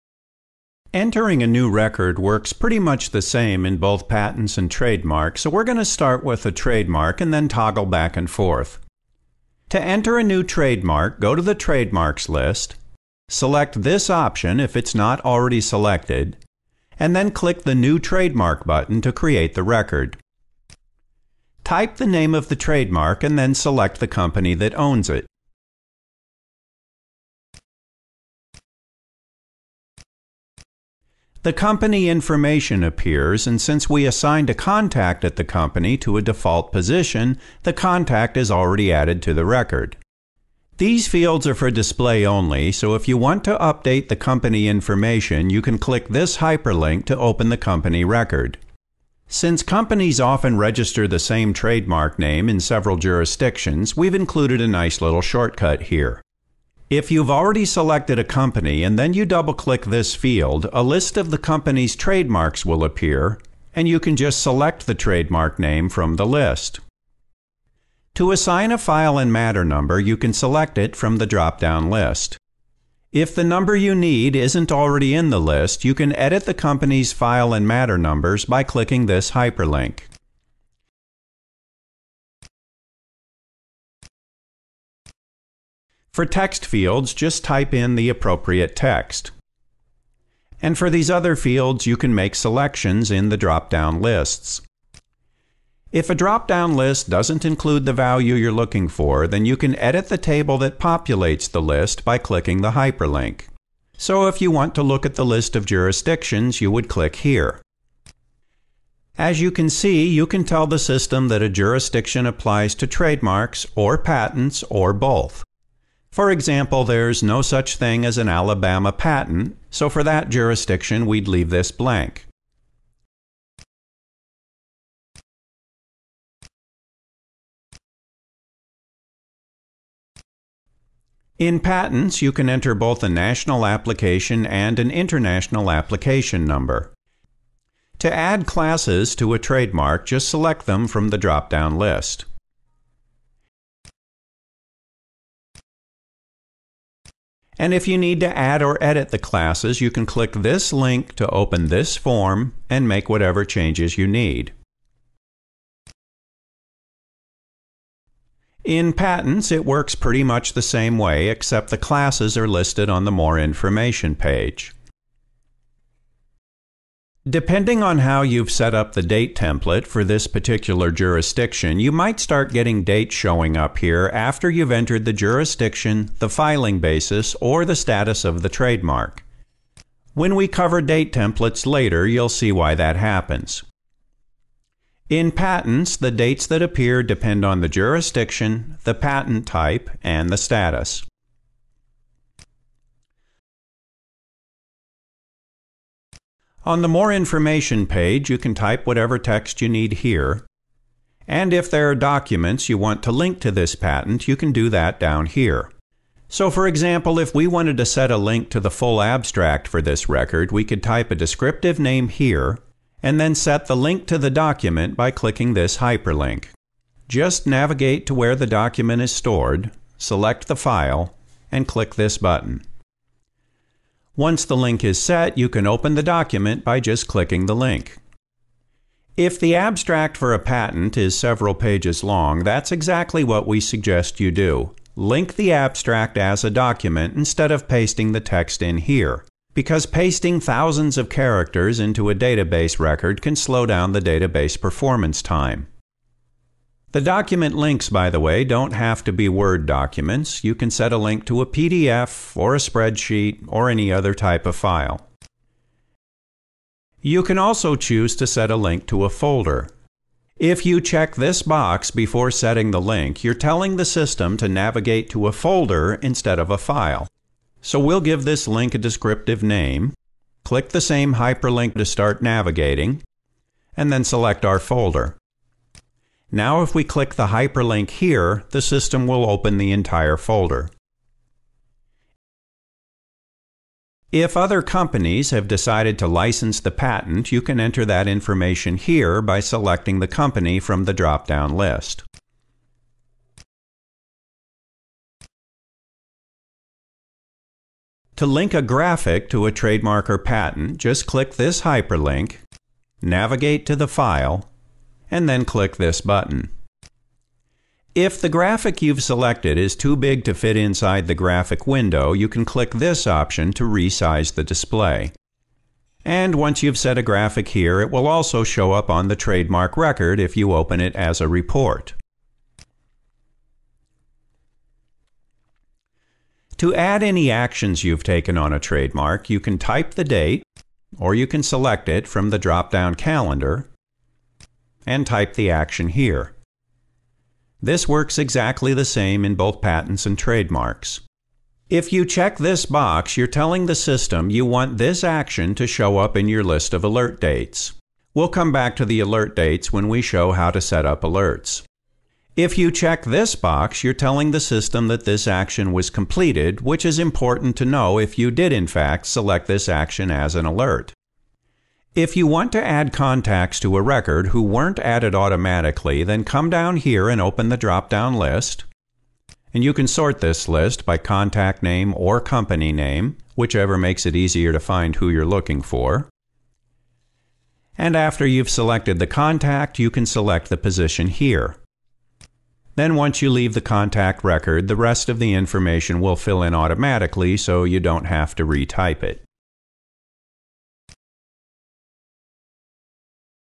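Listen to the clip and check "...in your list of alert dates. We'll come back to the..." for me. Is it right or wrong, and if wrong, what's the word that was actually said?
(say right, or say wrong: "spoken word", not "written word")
right.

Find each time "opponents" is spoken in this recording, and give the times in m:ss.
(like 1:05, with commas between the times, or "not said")
not said.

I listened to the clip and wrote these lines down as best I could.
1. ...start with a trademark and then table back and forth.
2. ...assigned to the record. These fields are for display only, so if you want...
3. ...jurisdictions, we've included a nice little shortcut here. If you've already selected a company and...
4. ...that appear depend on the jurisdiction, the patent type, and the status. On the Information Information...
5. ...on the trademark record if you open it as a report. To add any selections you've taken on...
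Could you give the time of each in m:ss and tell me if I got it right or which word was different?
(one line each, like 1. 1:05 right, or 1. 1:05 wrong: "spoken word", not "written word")
1. 0:05 wrong: "toggle", not "table"
2. 0:38 wrong: "added", not "assigned"
3. 0:52 right
4. 3:06 wrong: "More", not "Information"
5. 5:18 wrong: "actions", not "selections".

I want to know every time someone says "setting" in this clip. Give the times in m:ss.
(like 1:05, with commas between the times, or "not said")
4:22.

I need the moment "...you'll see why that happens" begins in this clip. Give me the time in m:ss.
3:02.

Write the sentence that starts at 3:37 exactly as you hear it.
Just navigate to where the document is stored, select the file, and click this button.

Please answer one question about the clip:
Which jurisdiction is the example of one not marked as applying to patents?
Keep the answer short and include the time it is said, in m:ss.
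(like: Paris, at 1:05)
Alabama, at 1:58.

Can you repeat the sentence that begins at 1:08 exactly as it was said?
To assign a file and matter number, you can select it from the drop down list.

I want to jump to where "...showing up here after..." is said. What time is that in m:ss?
2:53.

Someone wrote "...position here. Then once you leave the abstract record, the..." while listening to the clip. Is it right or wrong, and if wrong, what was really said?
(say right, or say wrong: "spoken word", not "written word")
wrong: "contact", not "abstract".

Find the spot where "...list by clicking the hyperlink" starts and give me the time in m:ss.
1:41.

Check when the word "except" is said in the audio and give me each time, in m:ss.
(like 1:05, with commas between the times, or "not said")
2:41.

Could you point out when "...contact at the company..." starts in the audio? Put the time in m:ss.
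0:34.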